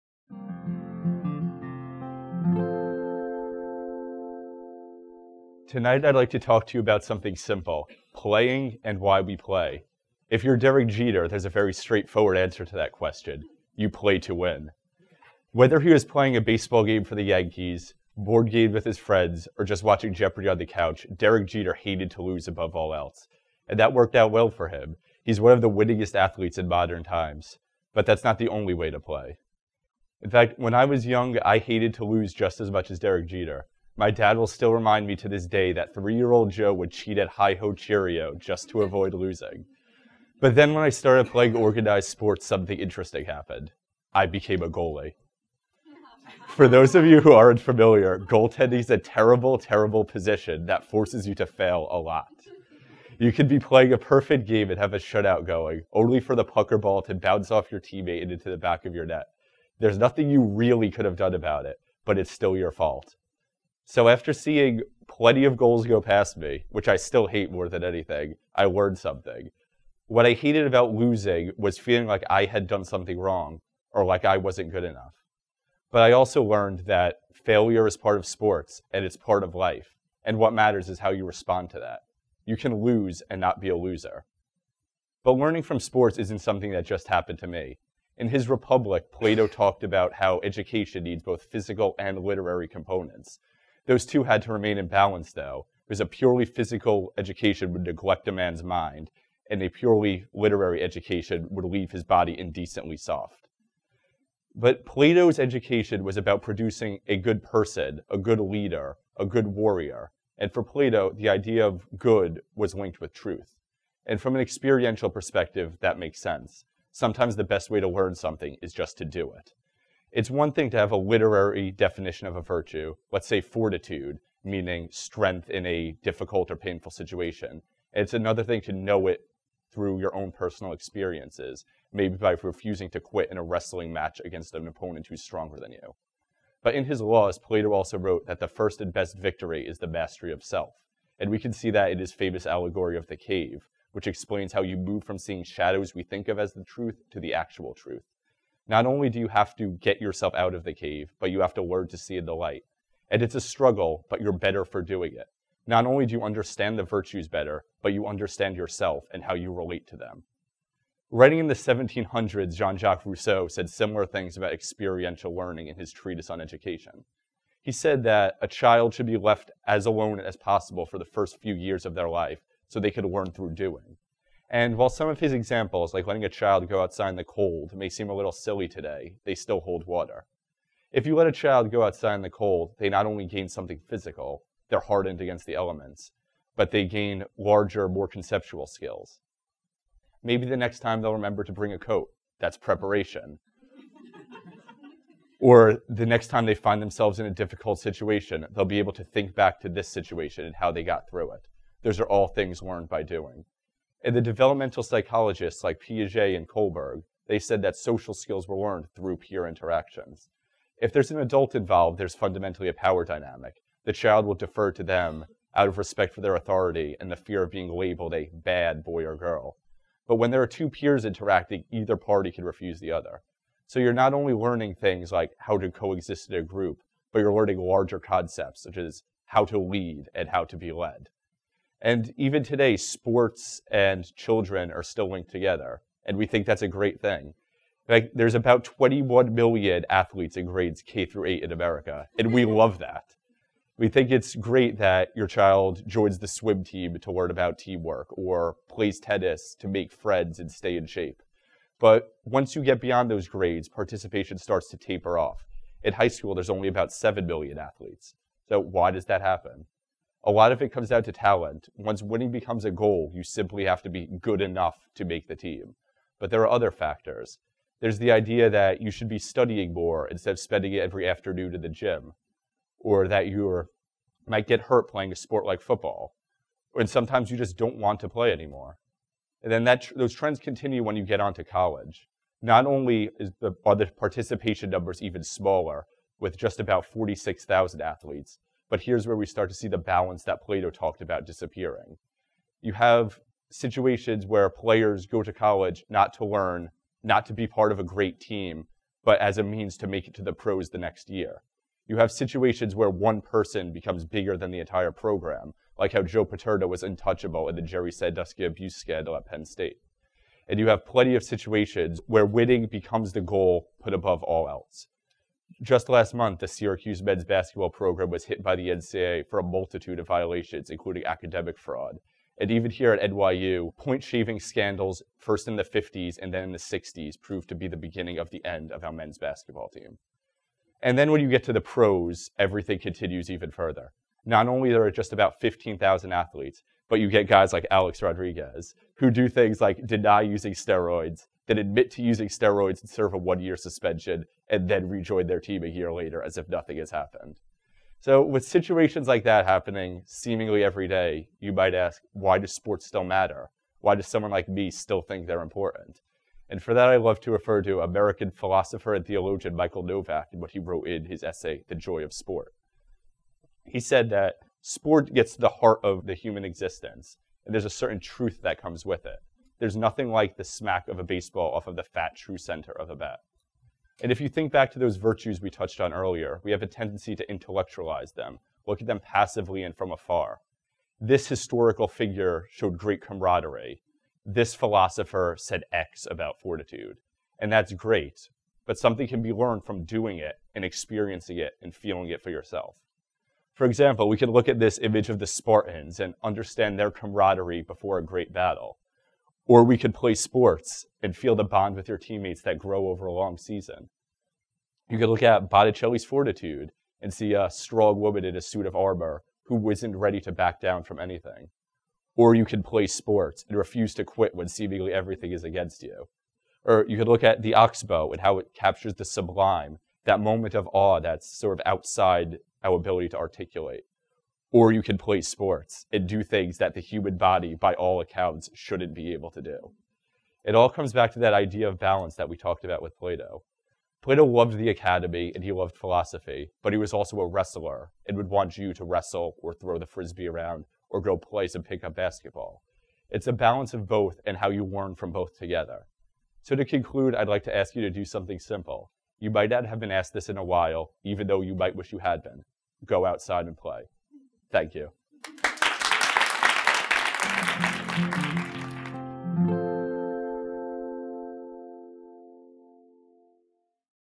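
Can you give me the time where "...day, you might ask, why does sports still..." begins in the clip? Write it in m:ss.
5:50.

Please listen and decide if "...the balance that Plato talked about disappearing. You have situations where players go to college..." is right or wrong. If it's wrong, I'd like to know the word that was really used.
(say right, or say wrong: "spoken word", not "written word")
right.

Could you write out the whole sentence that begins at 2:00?
It's one thing to have a literary definition of a virtue, let's say fortitude, meaning strength in a difficult or painful situation.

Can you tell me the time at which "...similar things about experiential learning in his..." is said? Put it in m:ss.
2:43.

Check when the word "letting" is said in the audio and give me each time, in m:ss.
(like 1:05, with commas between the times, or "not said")
2:56.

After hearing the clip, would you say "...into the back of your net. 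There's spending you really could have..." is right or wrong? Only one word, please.
wrong.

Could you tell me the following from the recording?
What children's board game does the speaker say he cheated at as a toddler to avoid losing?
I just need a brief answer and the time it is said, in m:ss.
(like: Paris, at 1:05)
Hi Ho Cherry-O, at 0:37.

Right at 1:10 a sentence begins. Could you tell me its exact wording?
What I hated about losing was feeling like I had done something wrong or like I wasn't good enough.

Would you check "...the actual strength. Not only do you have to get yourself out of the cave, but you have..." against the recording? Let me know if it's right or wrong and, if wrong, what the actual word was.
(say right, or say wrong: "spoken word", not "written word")
wrong: "truth", not "strength".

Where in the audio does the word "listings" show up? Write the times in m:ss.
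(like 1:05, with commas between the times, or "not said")
not said.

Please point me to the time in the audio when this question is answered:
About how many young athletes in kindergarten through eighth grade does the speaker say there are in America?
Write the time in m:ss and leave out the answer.
3:58.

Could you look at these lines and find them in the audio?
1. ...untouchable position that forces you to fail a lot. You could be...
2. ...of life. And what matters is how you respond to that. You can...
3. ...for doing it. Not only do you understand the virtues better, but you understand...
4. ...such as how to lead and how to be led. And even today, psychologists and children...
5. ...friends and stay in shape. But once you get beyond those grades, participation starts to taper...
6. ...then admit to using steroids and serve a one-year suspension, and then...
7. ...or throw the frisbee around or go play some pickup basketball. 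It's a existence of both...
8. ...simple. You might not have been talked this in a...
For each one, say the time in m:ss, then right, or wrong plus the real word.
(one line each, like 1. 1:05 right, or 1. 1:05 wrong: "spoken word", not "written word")
1. 0:49 wrong: "terrible", not "untouchable"
2. 1:19 right
3. 2:34 right
4. 3:48 wrong: "sports", not "psychologists"
5. 4:09 right
6. 5:41 right
7. 7:19 wrong: "balance", not "existence"
8. 7:28 wrong: "asked", not "talked".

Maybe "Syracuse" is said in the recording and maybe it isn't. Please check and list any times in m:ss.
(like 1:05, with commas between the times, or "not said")
5:16.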